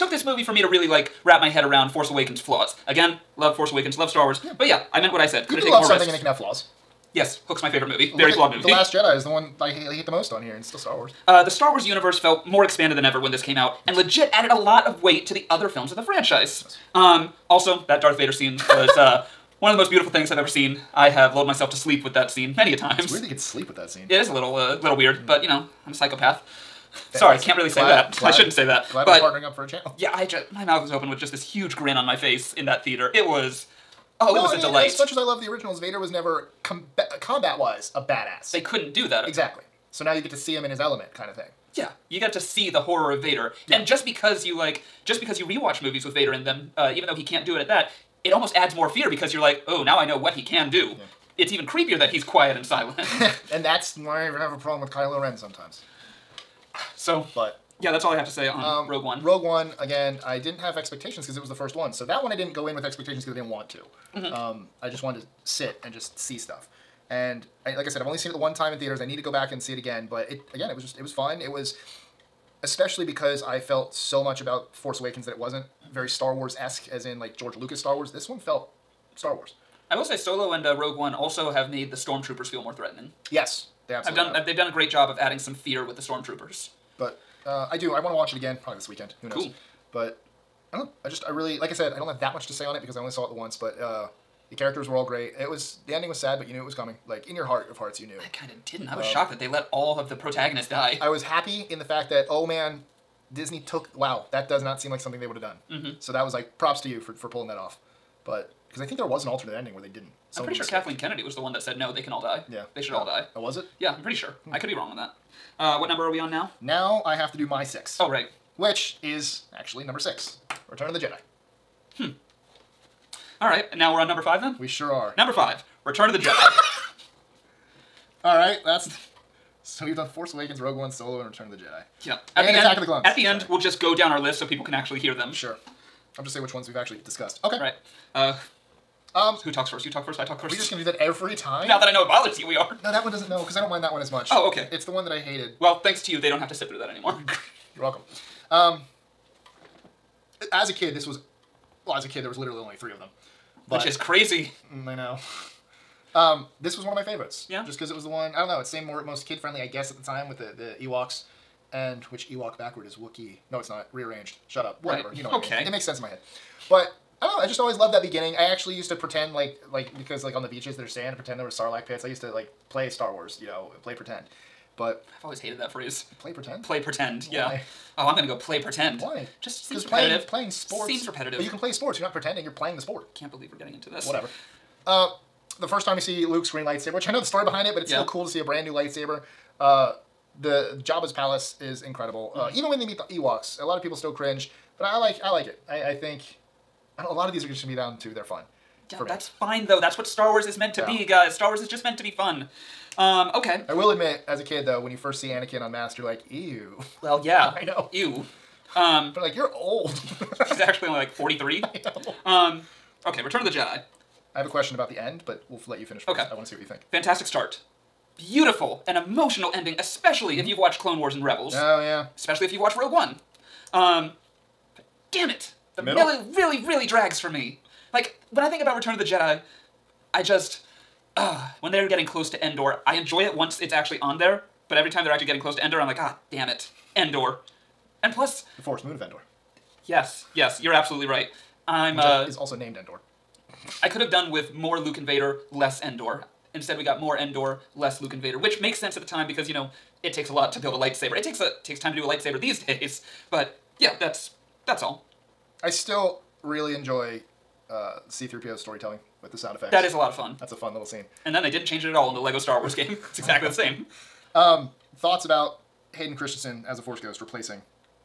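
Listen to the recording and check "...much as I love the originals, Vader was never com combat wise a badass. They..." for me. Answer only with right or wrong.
right.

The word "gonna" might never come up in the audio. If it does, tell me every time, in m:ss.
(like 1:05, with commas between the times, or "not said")
2:20, 2:58.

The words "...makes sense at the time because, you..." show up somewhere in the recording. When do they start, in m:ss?
4:08.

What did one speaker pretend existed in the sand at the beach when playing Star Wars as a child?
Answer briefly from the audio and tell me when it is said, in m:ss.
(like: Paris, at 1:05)
sarlacc pits, at 2:51.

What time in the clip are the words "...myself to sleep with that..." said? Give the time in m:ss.
0:21.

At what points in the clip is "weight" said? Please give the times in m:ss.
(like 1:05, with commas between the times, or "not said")
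0:15.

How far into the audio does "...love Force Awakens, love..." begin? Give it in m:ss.
0:03.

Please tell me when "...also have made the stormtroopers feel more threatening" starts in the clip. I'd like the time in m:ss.
1:21.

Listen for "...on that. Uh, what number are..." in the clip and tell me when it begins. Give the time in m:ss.
1:54.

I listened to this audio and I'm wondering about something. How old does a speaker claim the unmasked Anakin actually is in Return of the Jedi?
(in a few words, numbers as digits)
43.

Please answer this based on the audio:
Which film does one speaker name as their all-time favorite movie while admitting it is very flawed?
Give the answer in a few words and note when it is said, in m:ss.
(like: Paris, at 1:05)
Hook, at 0:07.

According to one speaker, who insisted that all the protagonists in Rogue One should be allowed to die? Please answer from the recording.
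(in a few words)
Kathleen Kennedy.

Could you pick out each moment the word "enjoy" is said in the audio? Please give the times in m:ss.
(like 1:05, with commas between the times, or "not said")
3:52, 4:16.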